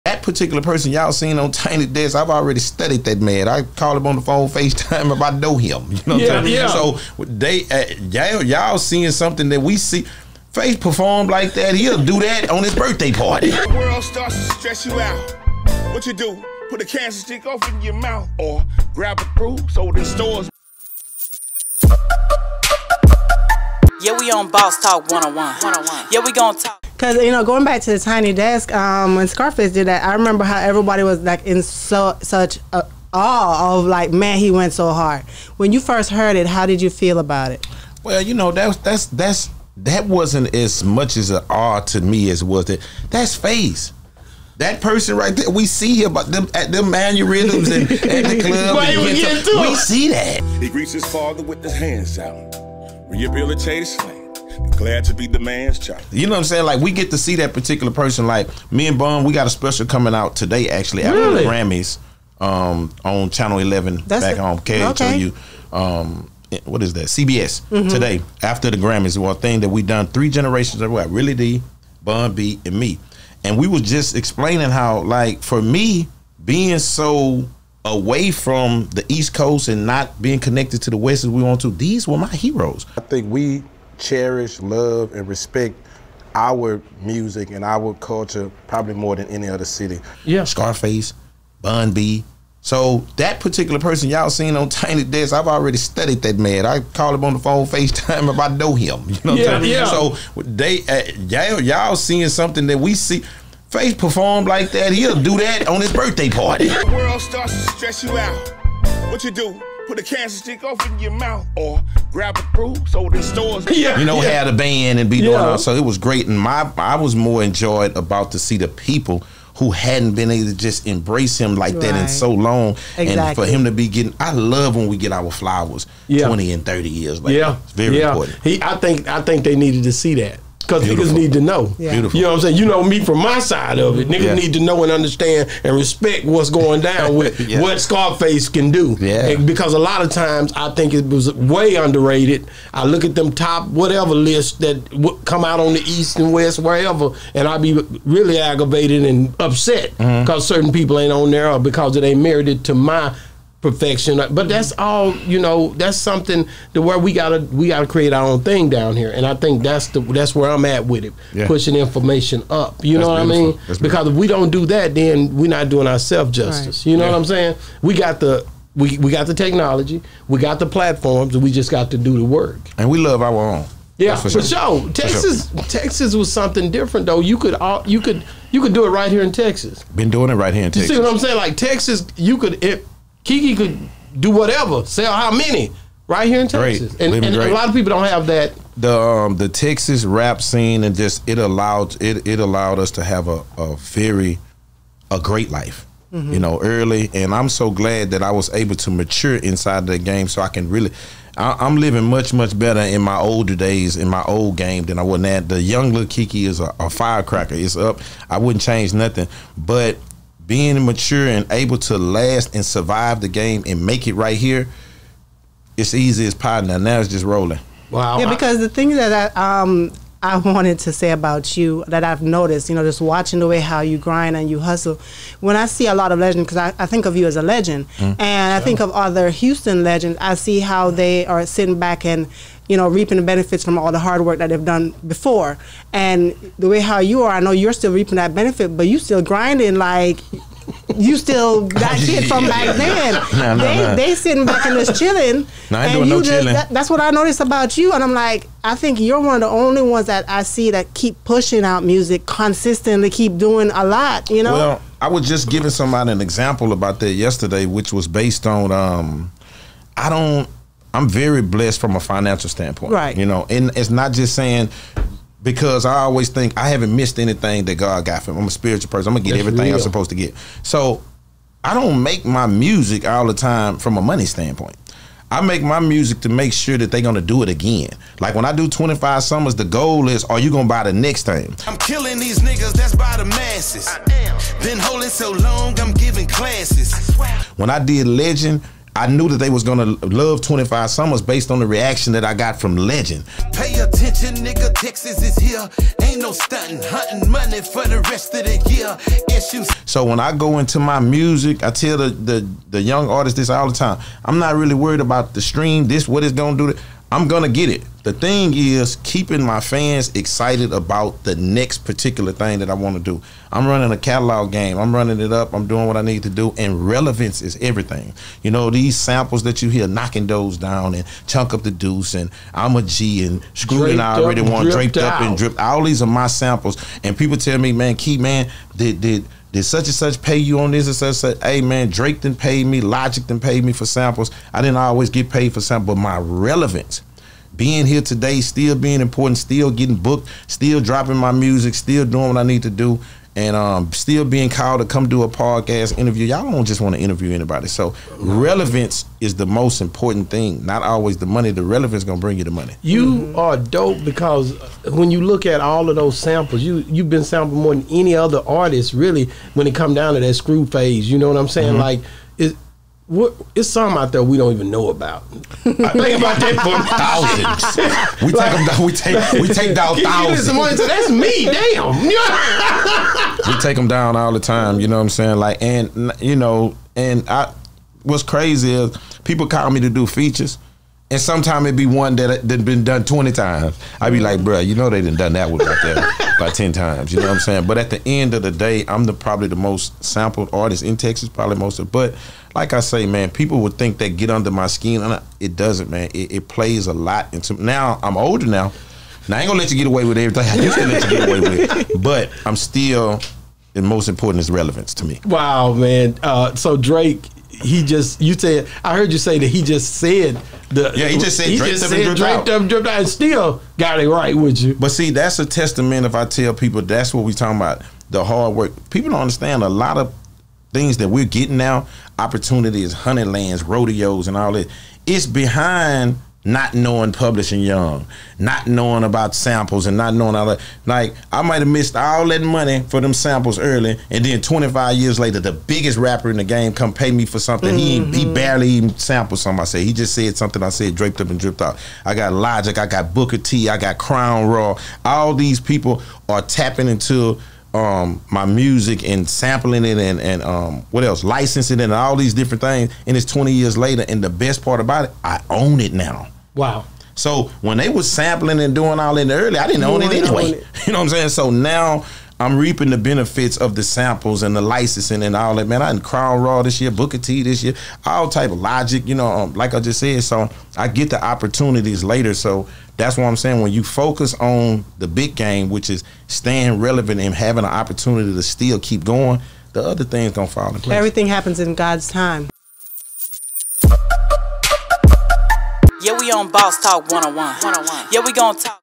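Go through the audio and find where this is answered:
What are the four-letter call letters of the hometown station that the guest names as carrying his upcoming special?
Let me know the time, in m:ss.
1:04.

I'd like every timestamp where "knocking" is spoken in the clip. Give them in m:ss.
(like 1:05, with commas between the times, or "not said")
5:19.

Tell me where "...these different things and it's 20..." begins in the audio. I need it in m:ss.
7:32.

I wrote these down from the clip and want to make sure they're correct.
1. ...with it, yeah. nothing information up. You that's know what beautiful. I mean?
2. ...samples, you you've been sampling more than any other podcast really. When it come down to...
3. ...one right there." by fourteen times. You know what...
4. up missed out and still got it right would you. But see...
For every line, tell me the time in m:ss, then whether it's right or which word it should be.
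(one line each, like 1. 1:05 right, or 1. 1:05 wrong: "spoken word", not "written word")
1. 2:40 wrong: "pushing", not "nothing"
2. 5:56 wrong: "artist", not "podcast"
3. 6:25 wrong: "ten", not "fourteen"
4. 6:52 wrong: "dripped", not "missed".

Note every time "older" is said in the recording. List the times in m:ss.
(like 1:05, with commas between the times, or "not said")
3:23, 6:38.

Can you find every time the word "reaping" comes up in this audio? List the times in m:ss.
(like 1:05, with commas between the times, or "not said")
3:52, 3:57, 7:42.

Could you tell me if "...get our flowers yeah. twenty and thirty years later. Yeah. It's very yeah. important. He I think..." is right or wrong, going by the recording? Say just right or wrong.
right.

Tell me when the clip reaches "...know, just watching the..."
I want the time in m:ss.
3:42.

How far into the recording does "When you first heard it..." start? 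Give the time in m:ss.
0:35.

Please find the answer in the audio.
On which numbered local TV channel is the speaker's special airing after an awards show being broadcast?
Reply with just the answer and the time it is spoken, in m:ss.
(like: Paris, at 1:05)
Channel 11, at 1:03.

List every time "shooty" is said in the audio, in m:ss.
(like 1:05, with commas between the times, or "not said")
not said.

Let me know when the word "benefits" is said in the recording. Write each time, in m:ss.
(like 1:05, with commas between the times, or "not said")
3:53, 3:58, 7:42.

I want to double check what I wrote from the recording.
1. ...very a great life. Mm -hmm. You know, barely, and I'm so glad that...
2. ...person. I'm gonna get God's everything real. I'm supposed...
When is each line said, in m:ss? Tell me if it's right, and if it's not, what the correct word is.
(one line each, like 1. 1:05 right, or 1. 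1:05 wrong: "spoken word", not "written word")
1. 3:13 wrong: "early", not "barely"
2. 4:28 wrong: "That", not "God".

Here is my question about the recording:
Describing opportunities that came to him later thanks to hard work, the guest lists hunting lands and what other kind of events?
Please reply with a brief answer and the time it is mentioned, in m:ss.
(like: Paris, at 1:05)
Rodeos, at 7:03.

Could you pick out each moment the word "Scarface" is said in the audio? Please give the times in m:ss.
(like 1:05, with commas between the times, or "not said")
0:29, 1:30, 2:17.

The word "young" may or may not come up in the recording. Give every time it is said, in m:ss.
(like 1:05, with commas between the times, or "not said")
3:25, 5:02, 7:07.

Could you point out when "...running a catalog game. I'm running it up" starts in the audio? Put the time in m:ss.
5:13.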